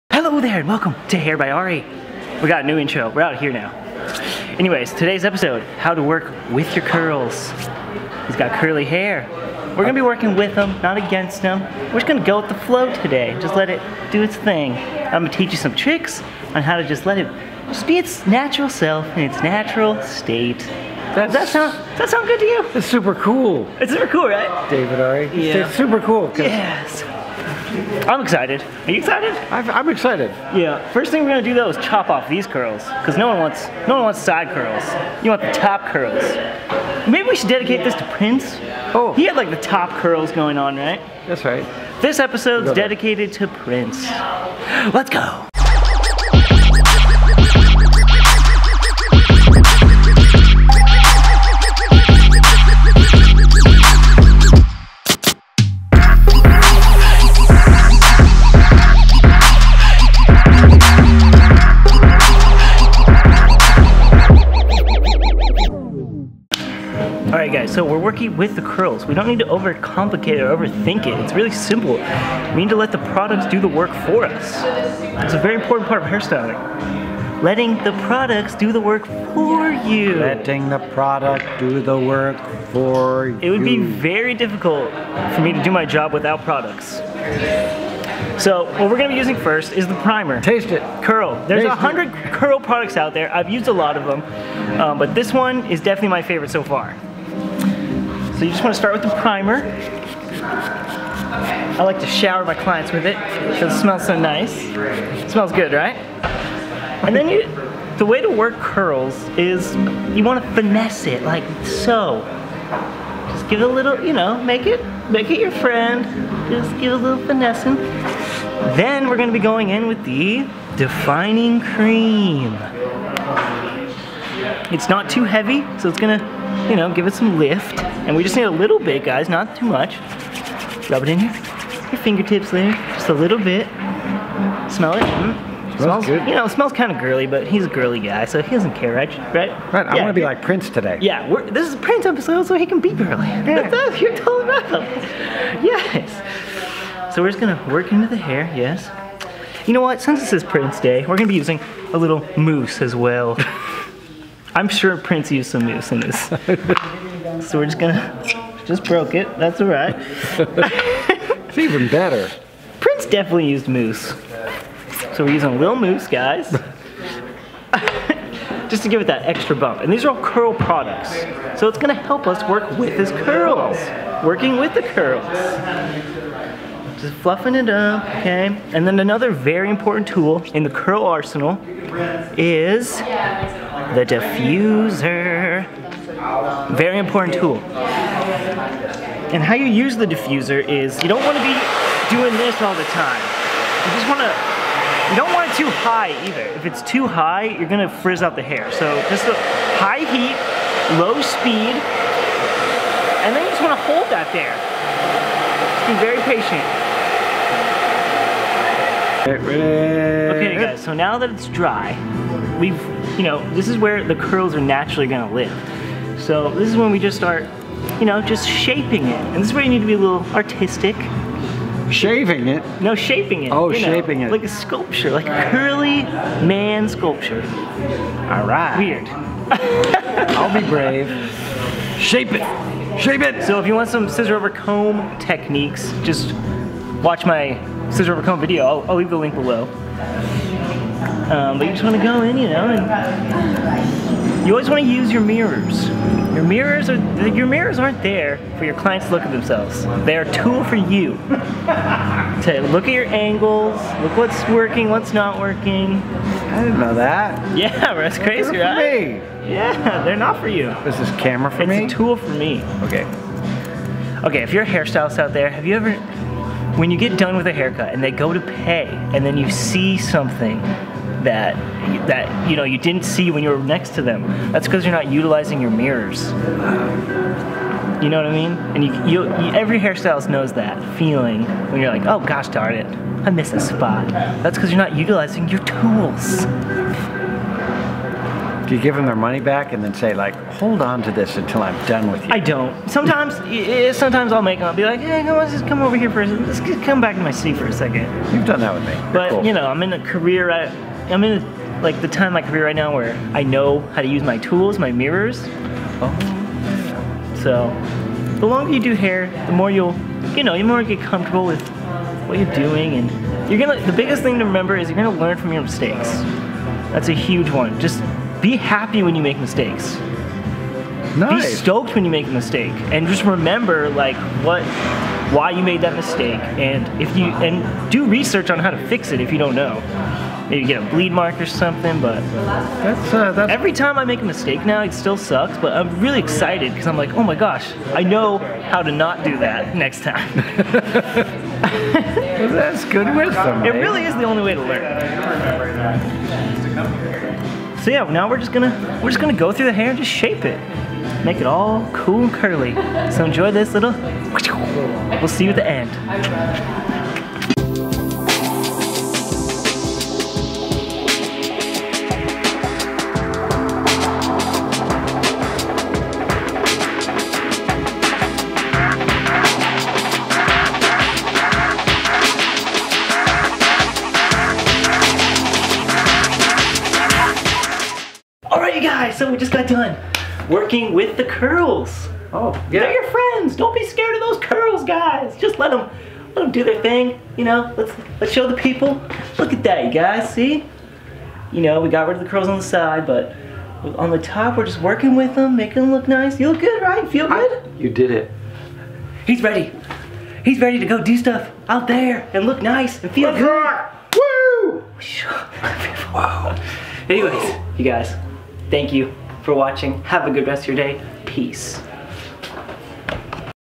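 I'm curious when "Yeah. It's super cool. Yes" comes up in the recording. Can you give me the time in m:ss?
0:25.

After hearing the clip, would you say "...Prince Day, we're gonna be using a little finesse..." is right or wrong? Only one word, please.
wrong.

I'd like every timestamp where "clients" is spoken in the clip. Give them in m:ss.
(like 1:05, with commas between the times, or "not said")
1:42, 4:08.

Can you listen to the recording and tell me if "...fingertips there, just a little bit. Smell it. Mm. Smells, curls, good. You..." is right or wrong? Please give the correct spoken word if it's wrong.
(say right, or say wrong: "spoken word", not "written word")
wrong: "smells", not "curls".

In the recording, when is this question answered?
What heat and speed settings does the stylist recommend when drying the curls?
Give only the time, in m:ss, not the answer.
3:19.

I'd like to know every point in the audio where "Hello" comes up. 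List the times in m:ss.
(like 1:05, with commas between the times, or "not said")
0:00.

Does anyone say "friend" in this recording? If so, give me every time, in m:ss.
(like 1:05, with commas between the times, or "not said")
1:55, 6:23.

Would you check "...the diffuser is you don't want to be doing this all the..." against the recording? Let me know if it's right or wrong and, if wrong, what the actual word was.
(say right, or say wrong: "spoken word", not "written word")
right.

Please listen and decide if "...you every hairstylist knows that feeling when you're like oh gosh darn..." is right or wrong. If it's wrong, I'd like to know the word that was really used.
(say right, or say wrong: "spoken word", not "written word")
right.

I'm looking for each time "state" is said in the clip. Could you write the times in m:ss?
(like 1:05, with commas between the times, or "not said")
0:20.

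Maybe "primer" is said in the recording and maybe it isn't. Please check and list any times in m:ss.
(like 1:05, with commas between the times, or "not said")
1:29, 1:39.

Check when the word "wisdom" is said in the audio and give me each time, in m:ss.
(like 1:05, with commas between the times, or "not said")
5:43.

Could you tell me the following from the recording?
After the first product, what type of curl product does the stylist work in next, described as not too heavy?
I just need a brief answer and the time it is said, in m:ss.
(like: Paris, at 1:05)
Defining cream, at 2:00.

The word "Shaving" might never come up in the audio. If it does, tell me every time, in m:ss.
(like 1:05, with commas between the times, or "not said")
3:41.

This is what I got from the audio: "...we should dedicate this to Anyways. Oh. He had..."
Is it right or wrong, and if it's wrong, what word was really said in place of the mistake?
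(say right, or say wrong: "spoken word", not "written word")
wrong: "Prince", not "Anyways".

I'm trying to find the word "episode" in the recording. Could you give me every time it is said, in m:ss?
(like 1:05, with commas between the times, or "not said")
0:05, 0:42, 2:22.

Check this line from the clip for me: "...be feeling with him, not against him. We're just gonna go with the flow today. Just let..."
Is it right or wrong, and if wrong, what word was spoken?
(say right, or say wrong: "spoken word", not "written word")
wrong: "working", not "feeling".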